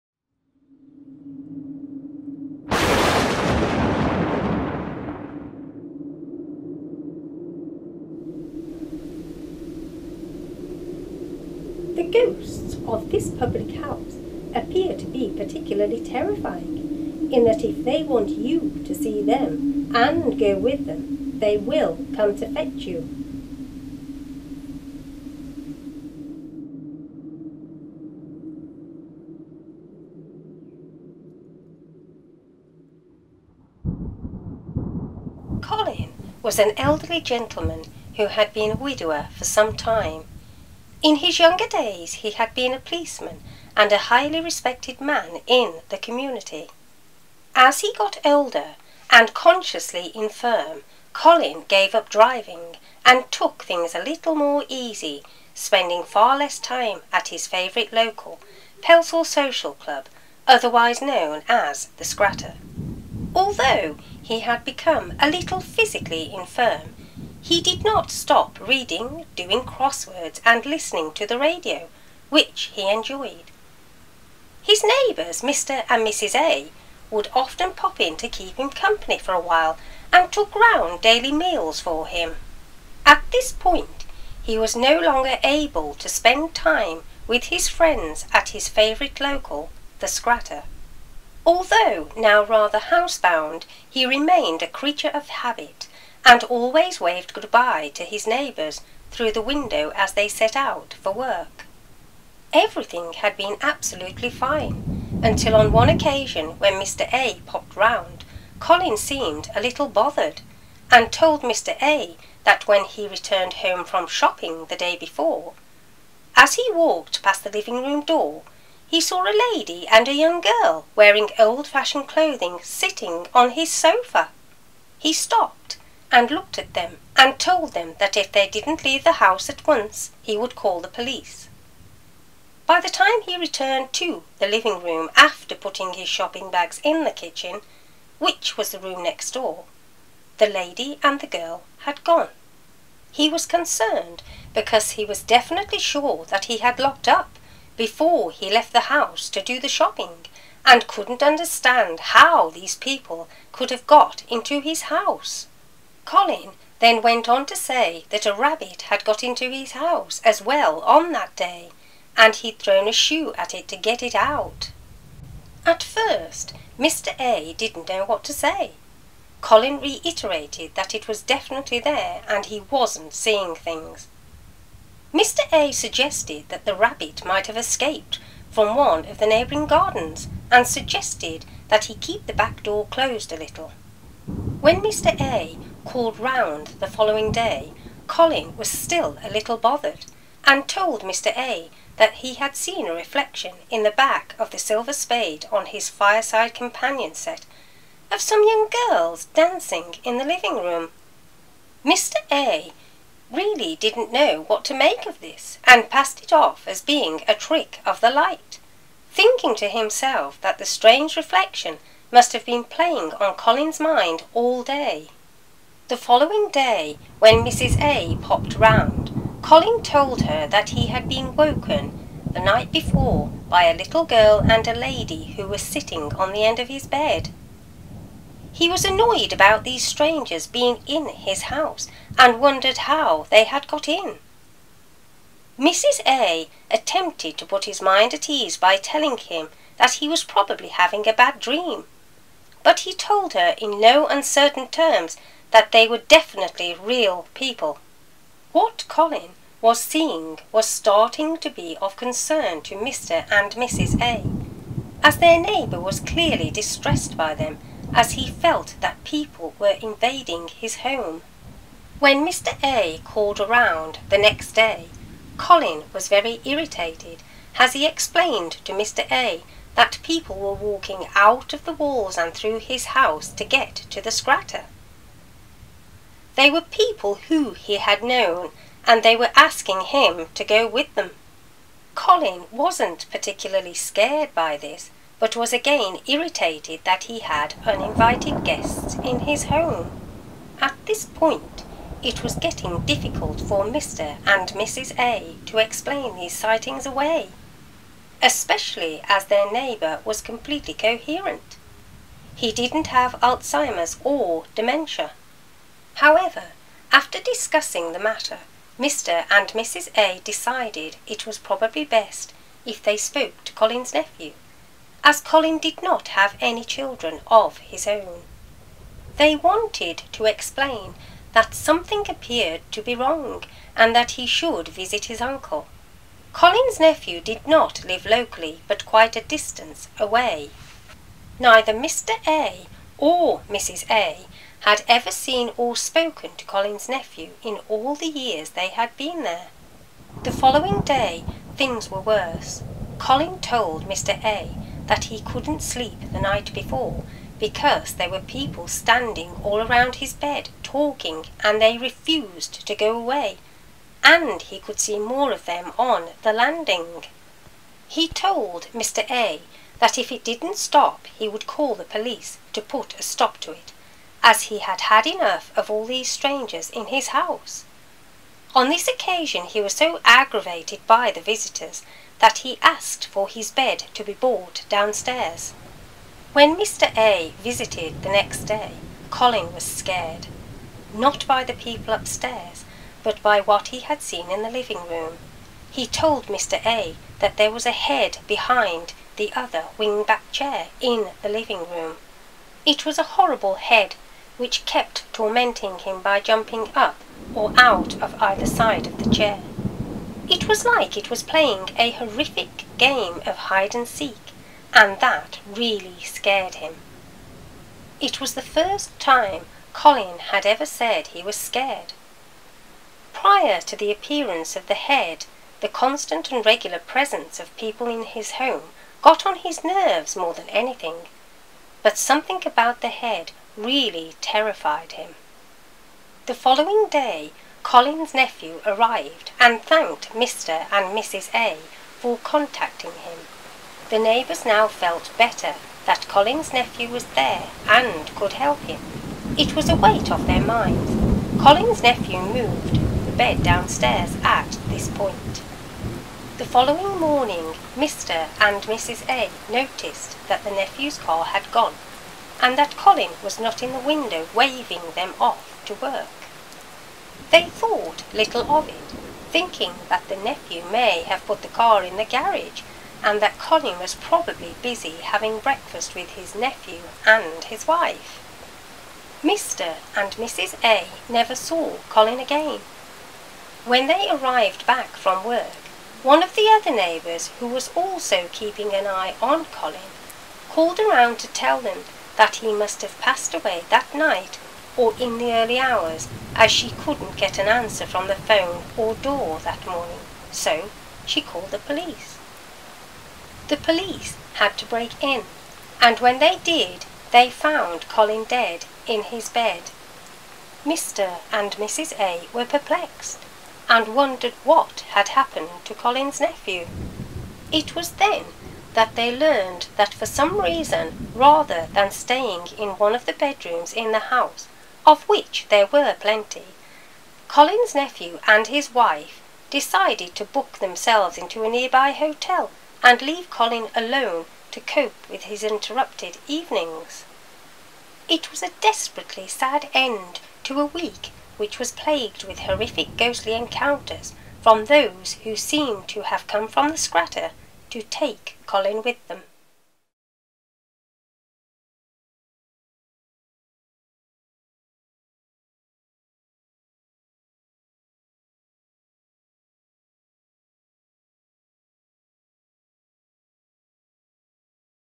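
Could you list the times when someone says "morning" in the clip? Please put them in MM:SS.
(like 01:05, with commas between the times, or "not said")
07:26, 08:09.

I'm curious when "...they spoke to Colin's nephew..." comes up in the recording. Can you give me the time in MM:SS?
05:12.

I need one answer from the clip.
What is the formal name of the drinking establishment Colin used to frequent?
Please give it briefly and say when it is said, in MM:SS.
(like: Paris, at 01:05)
Pelsall Social Club, at 00:58.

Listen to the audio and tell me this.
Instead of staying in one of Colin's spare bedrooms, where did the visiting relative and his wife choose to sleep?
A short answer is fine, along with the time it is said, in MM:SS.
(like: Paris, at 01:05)
A nearby hotel, at 08:41.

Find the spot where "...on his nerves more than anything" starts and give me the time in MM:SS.
06:59.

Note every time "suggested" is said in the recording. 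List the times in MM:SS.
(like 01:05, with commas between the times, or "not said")
02:55, 03:00.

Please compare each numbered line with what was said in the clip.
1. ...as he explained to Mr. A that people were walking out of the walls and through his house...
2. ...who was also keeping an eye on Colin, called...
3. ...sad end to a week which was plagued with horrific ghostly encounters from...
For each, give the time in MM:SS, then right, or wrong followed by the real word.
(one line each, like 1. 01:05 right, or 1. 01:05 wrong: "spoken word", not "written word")
1. 04:27 right
2. 07:57 right
3. 08:49 right.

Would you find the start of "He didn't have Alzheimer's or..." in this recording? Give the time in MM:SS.
05:02.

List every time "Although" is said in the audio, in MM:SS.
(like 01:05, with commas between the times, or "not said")
01:03, 01:31.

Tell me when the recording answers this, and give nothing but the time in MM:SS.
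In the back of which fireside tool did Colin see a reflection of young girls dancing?
03:14.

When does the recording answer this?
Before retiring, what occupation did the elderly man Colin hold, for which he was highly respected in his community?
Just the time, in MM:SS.
00:42.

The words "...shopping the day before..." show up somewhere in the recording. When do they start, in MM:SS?
01:54.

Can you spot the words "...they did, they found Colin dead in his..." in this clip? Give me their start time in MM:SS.
08:16.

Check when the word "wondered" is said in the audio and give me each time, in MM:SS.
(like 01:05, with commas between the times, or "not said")
03:52, 08:23.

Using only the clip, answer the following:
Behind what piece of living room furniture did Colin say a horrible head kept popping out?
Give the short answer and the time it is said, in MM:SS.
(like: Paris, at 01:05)
Wing-back chair, at 06:29.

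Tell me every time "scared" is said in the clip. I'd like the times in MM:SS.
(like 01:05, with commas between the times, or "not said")
04:43, 06:19, 06:46, 06:51.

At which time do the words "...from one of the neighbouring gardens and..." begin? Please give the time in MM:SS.
02:58.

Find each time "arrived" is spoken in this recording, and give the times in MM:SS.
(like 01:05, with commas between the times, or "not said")
07:08, 07:54.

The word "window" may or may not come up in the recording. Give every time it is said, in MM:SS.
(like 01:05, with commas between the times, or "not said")
01:39, 07:33.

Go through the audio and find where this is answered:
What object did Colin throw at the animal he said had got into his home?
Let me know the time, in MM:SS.
02:42.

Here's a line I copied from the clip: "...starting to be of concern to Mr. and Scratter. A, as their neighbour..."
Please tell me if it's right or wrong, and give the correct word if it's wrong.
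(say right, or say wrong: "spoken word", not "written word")
wrong: "Mrs", not "Scratter".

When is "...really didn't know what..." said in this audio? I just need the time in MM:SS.
03:23.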